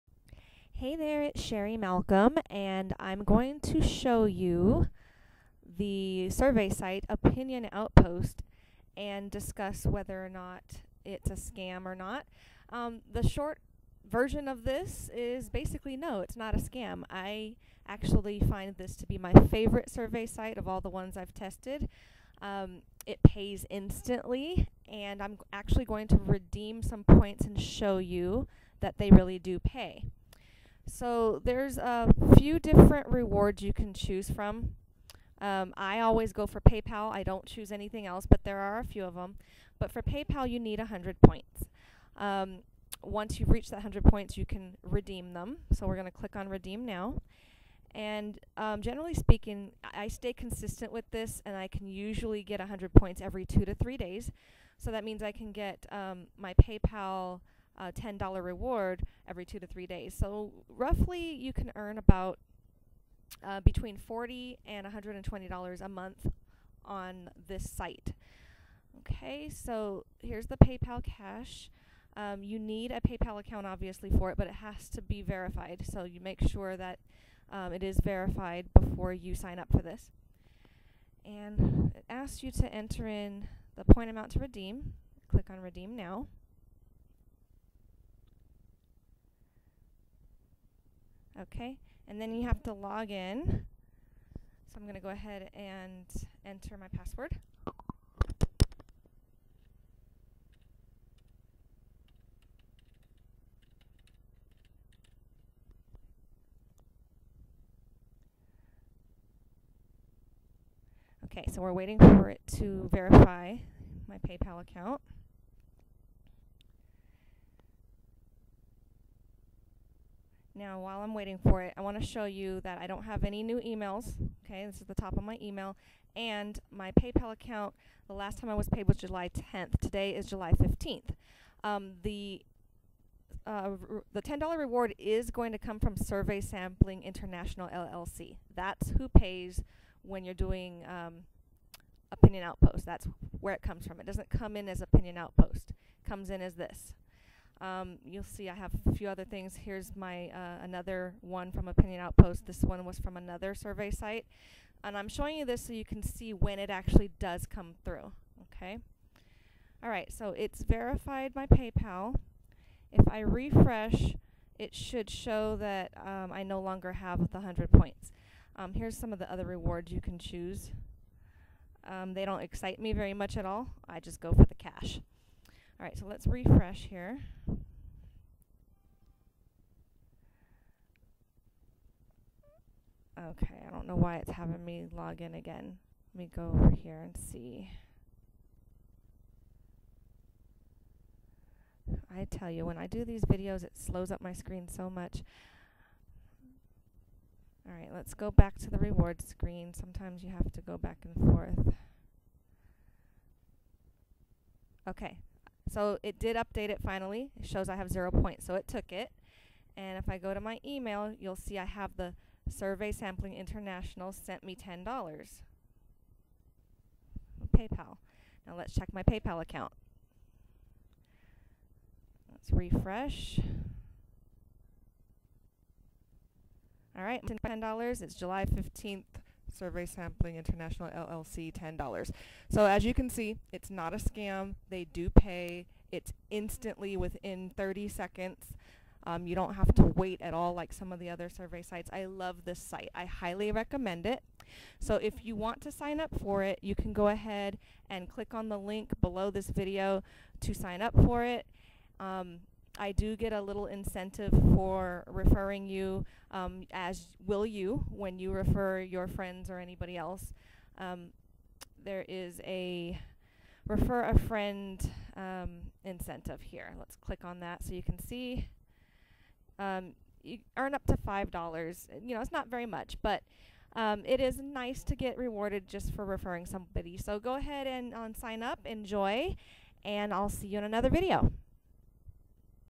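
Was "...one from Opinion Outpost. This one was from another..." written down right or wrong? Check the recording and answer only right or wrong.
right.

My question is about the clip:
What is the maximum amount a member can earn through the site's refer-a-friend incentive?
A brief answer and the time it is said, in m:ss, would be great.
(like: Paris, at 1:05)
$5, at 4:30.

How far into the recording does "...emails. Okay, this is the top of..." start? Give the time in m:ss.
2:03.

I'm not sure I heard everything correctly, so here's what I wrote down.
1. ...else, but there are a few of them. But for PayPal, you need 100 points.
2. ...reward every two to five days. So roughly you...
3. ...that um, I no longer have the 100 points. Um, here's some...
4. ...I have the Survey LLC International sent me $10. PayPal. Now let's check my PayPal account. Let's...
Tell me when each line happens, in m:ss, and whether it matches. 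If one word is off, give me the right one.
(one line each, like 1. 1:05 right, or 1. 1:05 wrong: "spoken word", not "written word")
1. 0:38 right
2. 0:58 wrong: "three", not "five"
3. 2:45 right
4. 3:31 wrong: "Sampling", not "LLC".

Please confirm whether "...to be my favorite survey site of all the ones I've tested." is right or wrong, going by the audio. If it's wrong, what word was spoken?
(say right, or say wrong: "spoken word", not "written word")
right.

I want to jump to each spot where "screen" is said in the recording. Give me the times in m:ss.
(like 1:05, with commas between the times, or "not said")
3:14, 3:19.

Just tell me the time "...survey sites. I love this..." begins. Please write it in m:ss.
4:01.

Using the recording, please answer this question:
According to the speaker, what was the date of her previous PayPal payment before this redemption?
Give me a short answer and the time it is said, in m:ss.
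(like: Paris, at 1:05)
July 10th, at 2:08.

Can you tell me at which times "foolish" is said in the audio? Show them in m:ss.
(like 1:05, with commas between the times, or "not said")
not said.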